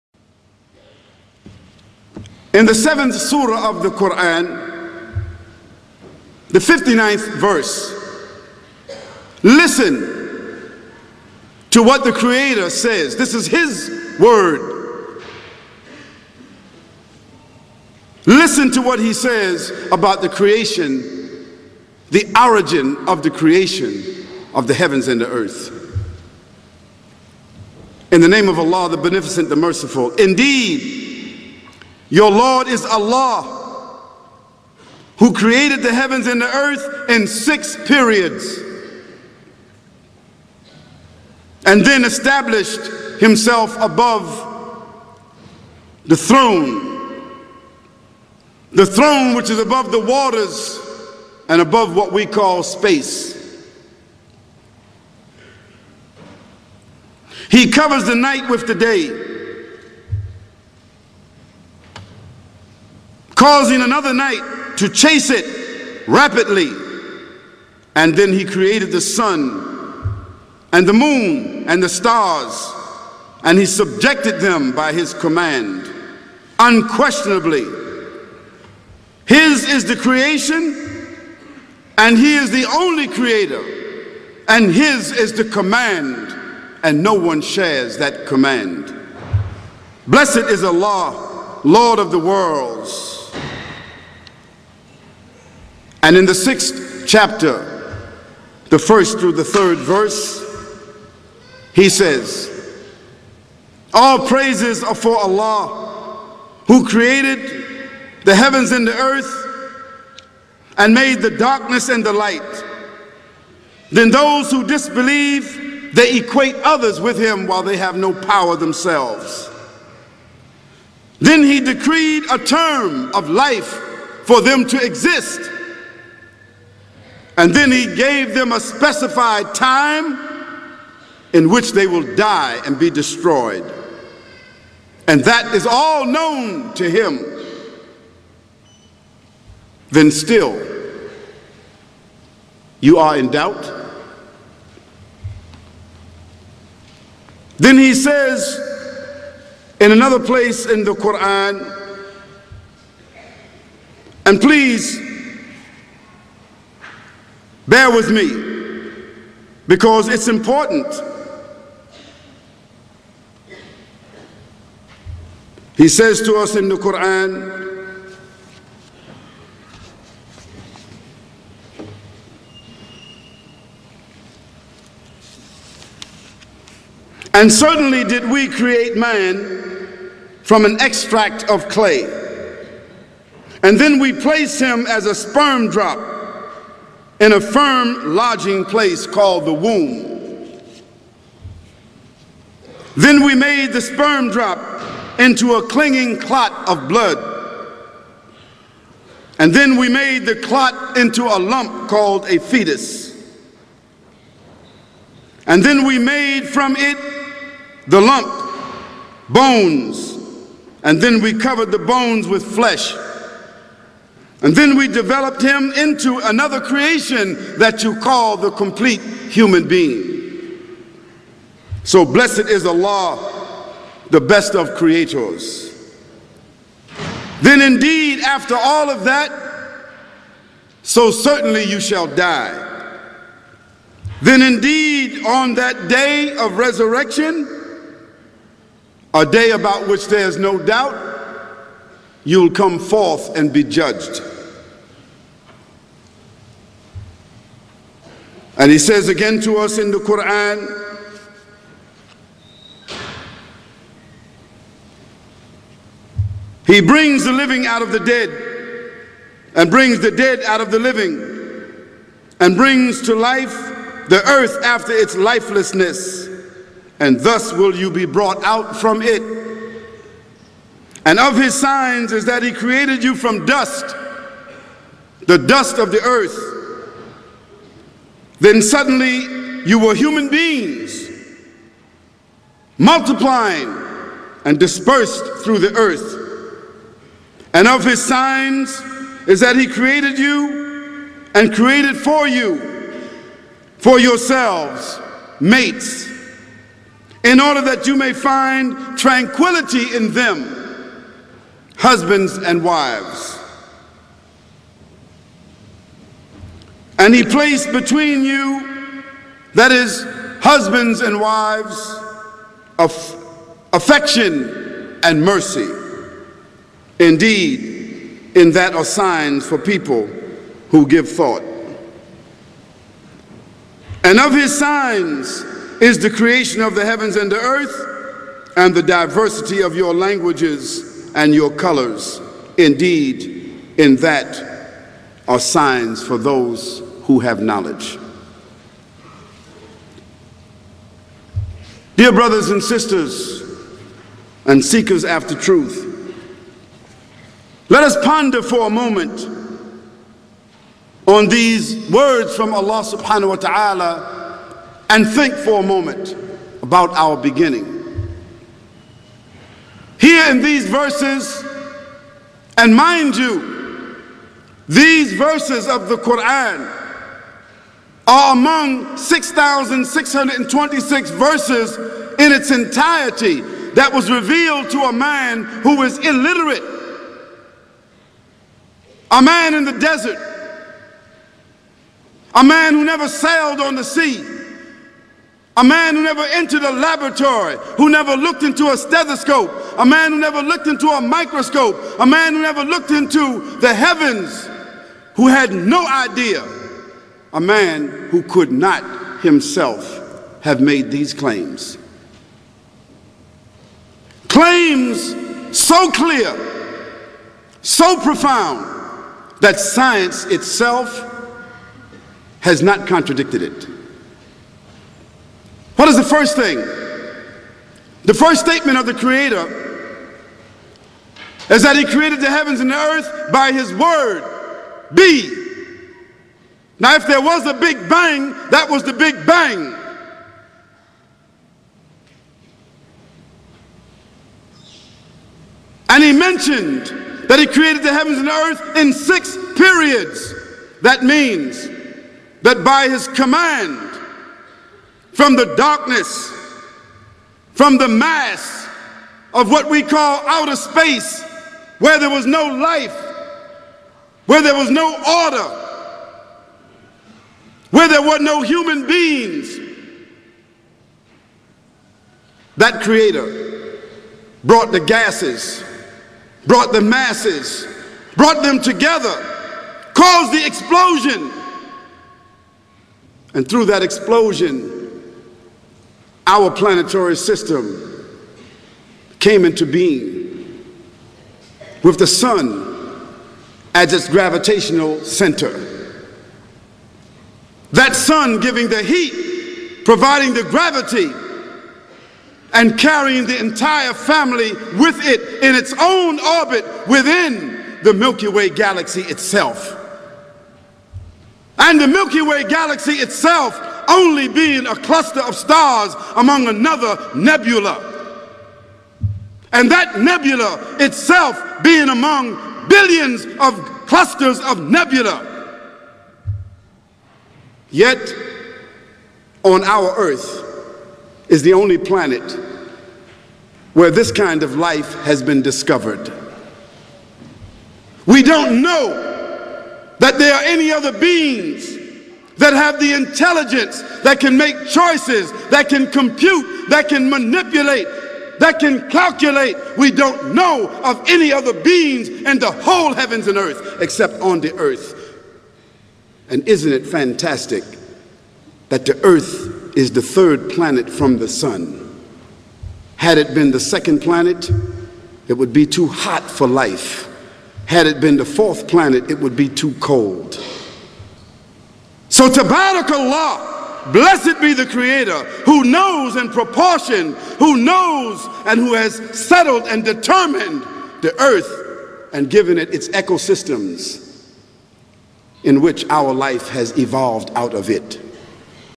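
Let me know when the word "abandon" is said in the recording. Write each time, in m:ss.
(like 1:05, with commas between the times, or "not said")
not said.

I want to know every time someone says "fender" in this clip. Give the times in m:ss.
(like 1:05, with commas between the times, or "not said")
not said.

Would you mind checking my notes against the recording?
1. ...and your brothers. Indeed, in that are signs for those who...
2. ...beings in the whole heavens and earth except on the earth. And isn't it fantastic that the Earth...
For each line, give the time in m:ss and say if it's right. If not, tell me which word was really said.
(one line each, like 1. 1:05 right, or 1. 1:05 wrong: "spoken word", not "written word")
1. 5:31 wrong: "colors", not "brothers"
2. 9:01 right.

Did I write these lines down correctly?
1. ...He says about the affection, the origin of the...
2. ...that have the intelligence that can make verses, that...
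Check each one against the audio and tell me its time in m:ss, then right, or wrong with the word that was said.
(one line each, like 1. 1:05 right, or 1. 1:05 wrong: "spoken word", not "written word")
1. 0:18 wrong: "creation", not "affection"
2. 8:52 wrong: "choices", not "verses".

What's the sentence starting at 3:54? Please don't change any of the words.
Then indeed, on that day of resurrection, a day about which there is no doubt, you'll come forth and be judged.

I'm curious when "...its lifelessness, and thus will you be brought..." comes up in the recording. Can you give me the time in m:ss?
4:24.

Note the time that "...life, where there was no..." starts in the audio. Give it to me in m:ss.
7:32.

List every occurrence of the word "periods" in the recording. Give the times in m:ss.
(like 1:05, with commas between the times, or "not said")
0:37, 7:19.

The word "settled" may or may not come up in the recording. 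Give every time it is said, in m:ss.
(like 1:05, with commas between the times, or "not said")
9:29.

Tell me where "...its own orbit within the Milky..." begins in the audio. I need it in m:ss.
8:15.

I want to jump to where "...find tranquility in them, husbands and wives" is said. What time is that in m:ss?
4:58.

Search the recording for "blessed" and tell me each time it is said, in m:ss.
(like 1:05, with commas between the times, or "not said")
1:30, 3:42, 9:23.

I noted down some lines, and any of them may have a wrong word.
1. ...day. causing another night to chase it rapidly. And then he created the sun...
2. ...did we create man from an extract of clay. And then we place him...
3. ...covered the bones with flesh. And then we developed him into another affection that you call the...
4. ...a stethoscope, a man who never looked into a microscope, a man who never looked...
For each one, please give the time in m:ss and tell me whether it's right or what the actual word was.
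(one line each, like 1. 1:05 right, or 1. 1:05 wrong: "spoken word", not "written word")
1. 0:58 right
2. 2:58 right
3. 3:31 wrong: "creation", not "affection"
4. 6:28 right.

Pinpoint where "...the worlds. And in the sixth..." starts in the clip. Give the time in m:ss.
1:32.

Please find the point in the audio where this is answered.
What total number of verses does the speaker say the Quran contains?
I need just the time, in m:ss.
6:08.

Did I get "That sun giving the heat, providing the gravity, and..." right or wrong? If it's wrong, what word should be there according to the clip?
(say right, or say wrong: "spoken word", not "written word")
right.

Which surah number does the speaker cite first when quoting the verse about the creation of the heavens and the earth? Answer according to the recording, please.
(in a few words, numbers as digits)
7.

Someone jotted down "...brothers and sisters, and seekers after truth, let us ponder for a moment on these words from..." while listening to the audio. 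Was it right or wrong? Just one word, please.
right.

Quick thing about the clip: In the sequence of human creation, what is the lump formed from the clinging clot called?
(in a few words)
fetus.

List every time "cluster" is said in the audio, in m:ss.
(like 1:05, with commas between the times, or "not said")
8:24, 8:33.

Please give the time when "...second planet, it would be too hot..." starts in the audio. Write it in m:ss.
9:13.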